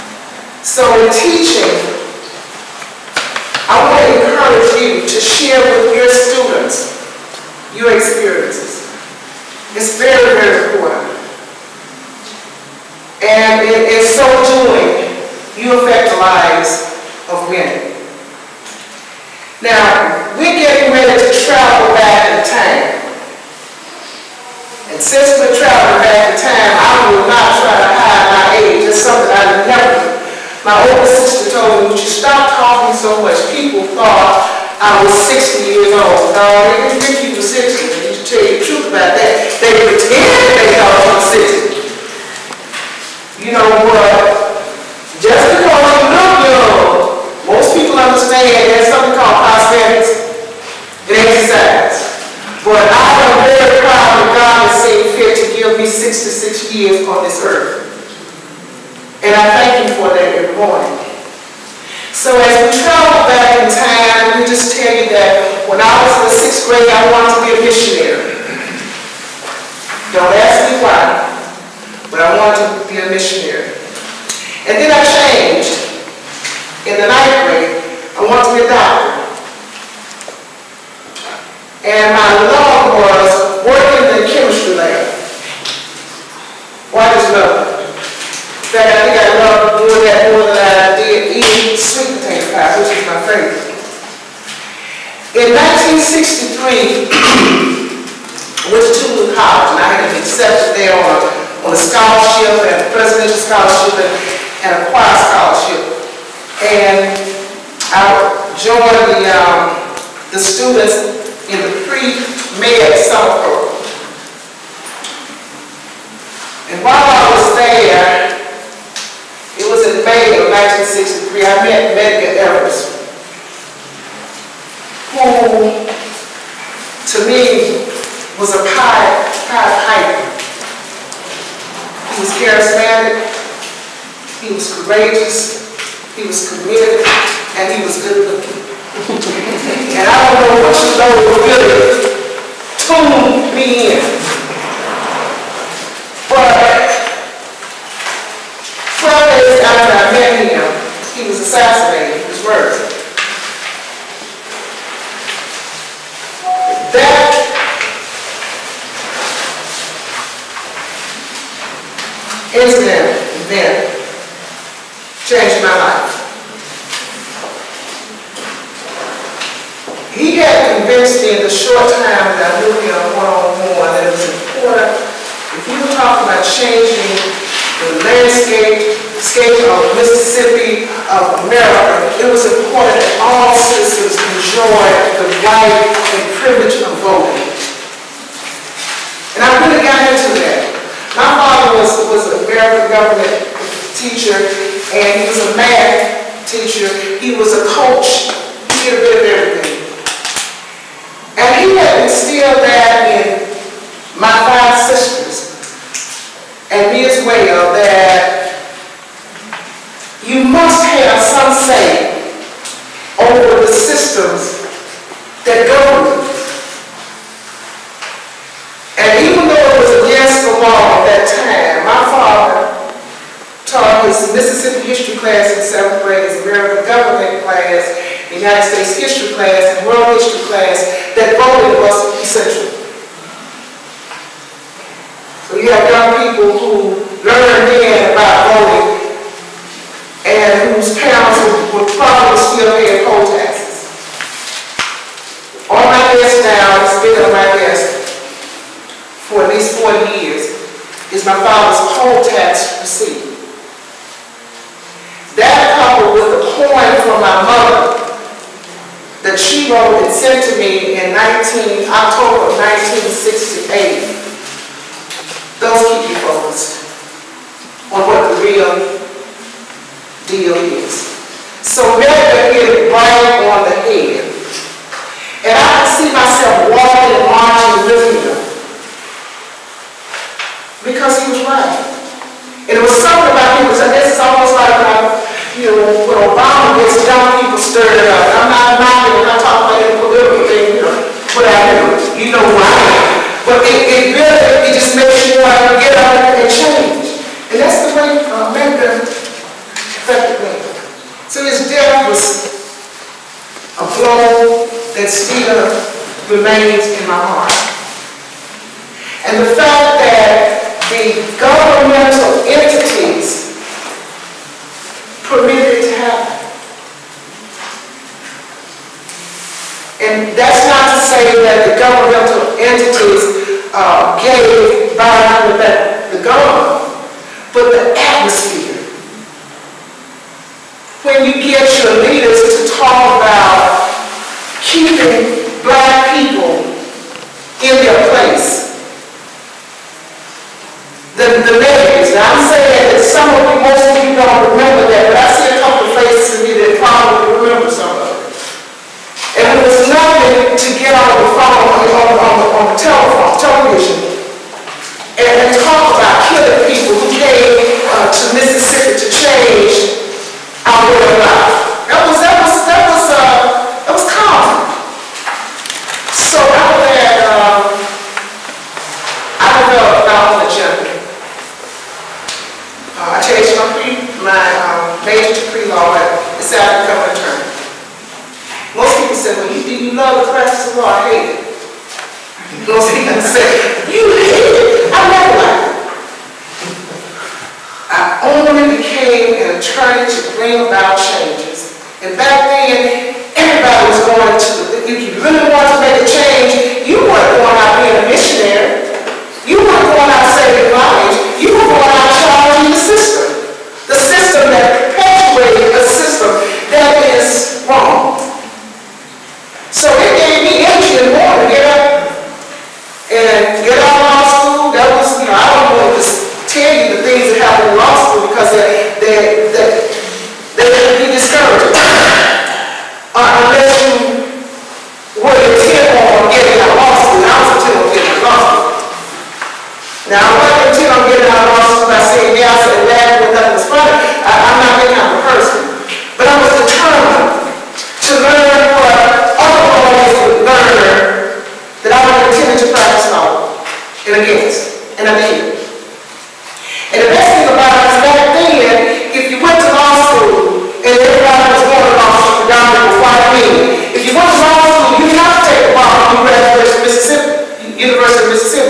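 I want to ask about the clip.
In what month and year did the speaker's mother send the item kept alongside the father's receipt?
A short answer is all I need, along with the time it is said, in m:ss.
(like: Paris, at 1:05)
October 1968, at 4:21.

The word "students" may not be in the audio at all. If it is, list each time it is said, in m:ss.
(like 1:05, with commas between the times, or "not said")
0:06, 1:50.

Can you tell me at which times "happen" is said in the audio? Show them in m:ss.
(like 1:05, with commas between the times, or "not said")
5:15.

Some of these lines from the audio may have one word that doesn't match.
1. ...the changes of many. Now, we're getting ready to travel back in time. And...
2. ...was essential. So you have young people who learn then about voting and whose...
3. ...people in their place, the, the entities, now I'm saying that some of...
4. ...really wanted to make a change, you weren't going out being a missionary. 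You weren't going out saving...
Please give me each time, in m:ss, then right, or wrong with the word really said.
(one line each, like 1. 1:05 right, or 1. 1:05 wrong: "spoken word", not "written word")
1. 0:16 wrong: "lives", not "changes"
2. 3:51 right
3. 5:36 wrong: "measures", not "entities"
4. 6:35 right.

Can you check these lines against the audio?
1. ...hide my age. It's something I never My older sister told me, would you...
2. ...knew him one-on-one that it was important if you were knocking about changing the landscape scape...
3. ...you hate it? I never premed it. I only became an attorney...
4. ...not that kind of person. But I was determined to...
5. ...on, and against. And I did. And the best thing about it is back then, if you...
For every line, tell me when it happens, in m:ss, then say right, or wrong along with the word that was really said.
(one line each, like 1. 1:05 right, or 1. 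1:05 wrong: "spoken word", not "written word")
1. 0:27 right
2. 2:52 wrong: "talking", not "knocking"
3. 6:23 wrong: "liked", not "premed"
4. 7:14 right
5. 7:23 right.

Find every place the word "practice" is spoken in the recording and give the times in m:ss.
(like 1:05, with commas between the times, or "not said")
6:20, 7:22.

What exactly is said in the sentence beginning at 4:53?
But it, it really, it just makes you want to get up and change.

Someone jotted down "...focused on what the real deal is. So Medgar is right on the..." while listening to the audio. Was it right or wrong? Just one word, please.
right.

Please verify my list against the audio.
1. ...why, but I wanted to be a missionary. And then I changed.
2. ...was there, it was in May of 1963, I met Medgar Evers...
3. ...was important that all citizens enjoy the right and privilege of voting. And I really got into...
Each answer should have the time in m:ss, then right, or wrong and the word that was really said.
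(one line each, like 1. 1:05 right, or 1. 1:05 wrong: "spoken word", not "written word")
1. 1:10 right
2. 1:57 right
3. 3:02 right.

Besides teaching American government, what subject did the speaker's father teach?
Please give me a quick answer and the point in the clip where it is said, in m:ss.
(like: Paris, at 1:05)
Math, at 3:15.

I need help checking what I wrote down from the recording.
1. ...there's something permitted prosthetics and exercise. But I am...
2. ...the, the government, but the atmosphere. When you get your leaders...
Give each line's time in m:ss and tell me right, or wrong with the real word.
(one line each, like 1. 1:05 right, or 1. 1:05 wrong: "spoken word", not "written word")
1. 0:48 wrong: "called", not "permitted"
2. 5:25 right.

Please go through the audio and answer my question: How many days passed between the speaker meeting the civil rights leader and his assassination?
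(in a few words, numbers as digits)
12.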